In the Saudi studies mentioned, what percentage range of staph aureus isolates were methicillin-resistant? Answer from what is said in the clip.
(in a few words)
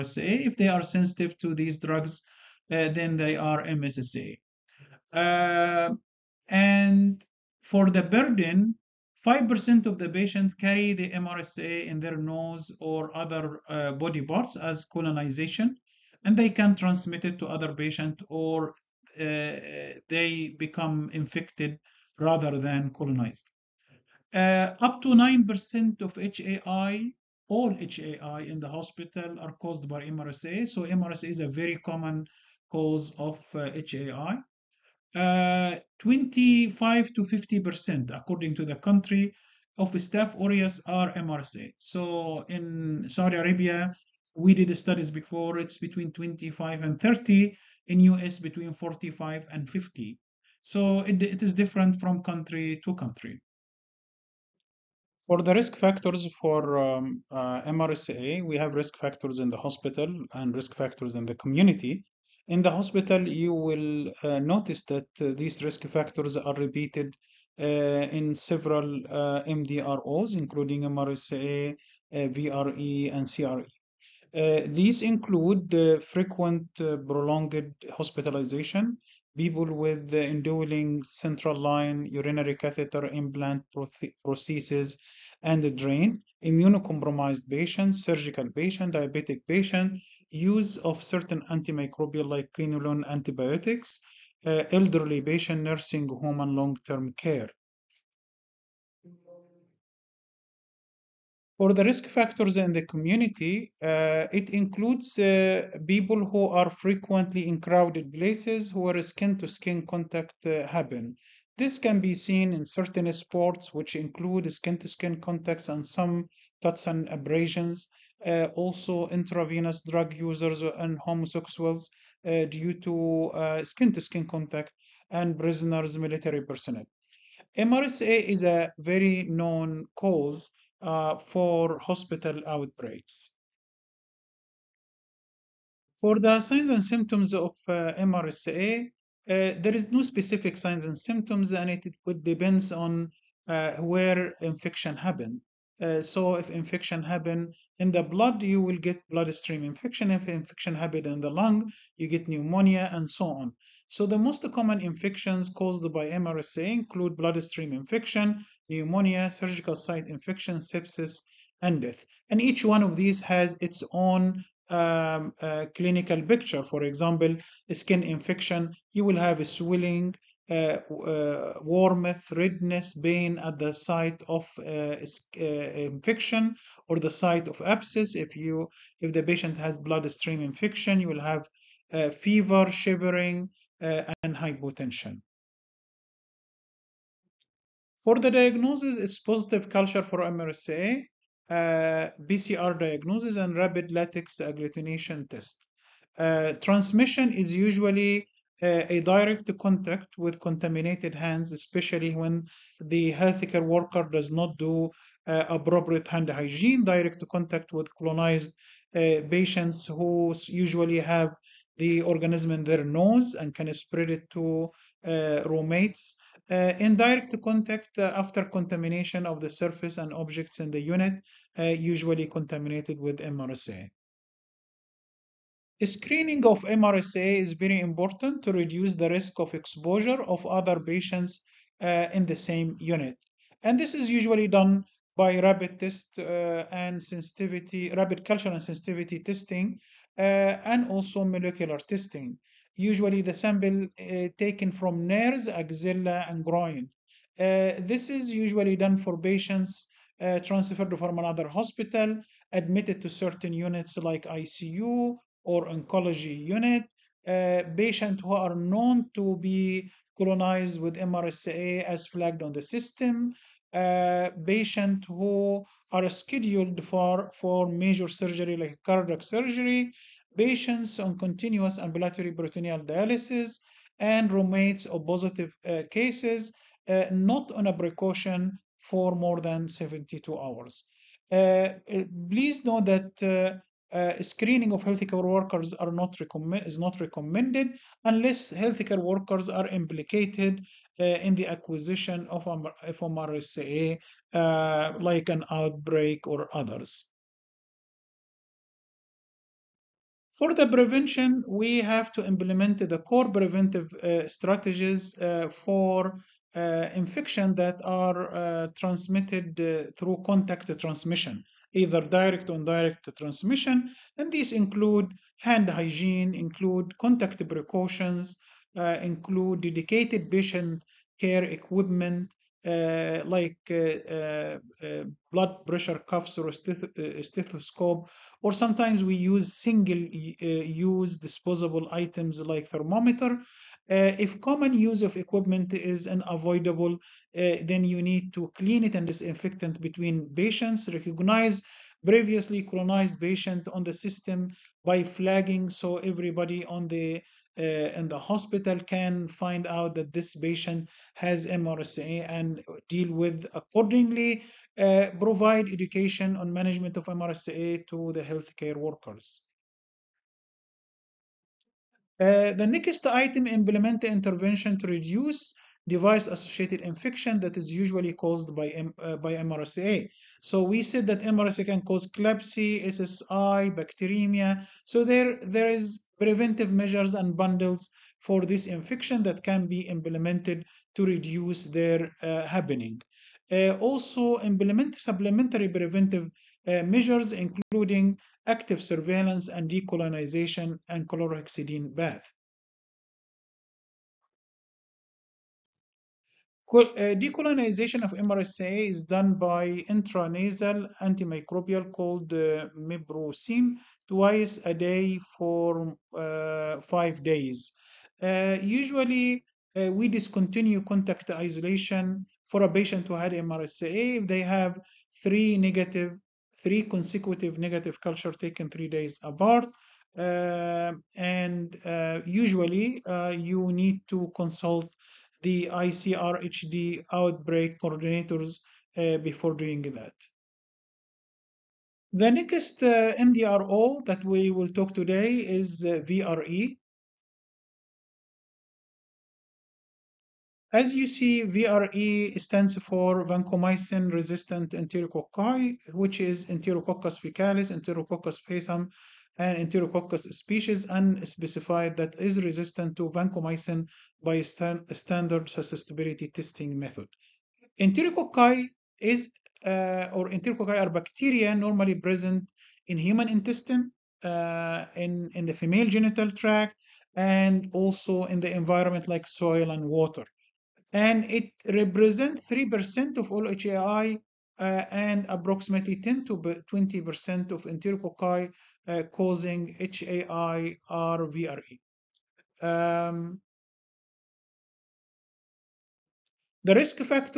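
25 to 30.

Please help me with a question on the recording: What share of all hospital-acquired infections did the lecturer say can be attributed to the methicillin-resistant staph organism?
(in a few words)
up to 9%.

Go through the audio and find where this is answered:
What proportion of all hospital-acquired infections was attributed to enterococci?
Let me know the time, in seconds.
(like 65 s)
472 s.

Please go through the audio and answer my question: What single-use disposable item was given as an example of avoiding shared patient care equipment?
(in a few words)
thermometer.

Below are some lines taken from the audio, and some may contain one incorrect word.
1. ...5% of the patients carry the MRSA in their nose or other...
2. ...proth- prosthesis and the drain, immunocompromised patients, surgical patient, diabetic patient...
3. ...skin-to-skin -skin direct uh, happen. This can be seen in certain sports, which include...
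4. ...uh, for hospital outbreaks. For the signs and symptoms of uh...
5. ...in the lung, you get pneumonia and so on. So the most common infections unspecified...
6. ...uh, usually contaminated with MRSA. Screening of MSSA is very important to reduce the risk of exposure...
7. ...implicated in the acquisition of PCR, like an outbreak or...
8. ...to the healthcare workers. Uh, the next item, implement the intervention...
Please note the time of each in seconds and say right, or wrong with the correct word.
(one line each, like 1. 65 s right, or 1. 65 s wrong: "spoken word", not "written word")
1. 9 s right
2. 83 s right
3. 109 s wrong: "contact", not "direct"
4. 130 s right
5. 151 s wrong: "caused", not "unspecified"
6. 221 s wrong: "MRSA", not "MSSA"
7. 289 s wrong: "FMRSA", not "PCR"
8. 357 s right.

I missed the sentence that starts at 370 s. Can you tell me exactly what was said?
So we said that MRSA can cause CLABSI, SSI, bacteremia.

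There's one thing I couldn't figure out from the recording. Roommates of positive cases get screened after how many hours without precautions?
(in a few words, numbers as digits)
72 hours.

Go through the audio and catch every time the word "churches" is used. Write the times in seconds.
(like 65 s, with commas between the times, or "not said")
not said.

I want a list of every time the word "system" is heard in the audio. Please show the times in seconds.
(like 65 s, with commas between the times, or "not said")
262 s, 343 s.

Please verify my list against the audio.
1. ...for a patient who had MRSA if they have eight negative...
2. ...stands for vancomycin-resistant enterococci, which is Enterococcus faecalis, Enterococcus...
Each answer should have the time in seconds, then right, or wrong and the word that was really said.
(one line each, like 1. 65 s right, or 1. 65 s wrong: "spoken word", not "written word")
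1. 412 s wrong: "three", not "eight"
2. 442 s right.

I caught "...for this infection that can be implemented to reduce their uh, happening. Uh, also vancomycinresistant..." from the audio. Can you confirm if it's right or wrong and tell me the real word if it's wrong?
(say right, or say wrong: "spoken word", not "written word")
wrong: "implement", not "vancomycinresistant".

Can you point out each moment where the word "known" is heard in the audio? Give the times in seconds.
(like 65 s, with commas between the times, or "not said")
129 s, 258 s.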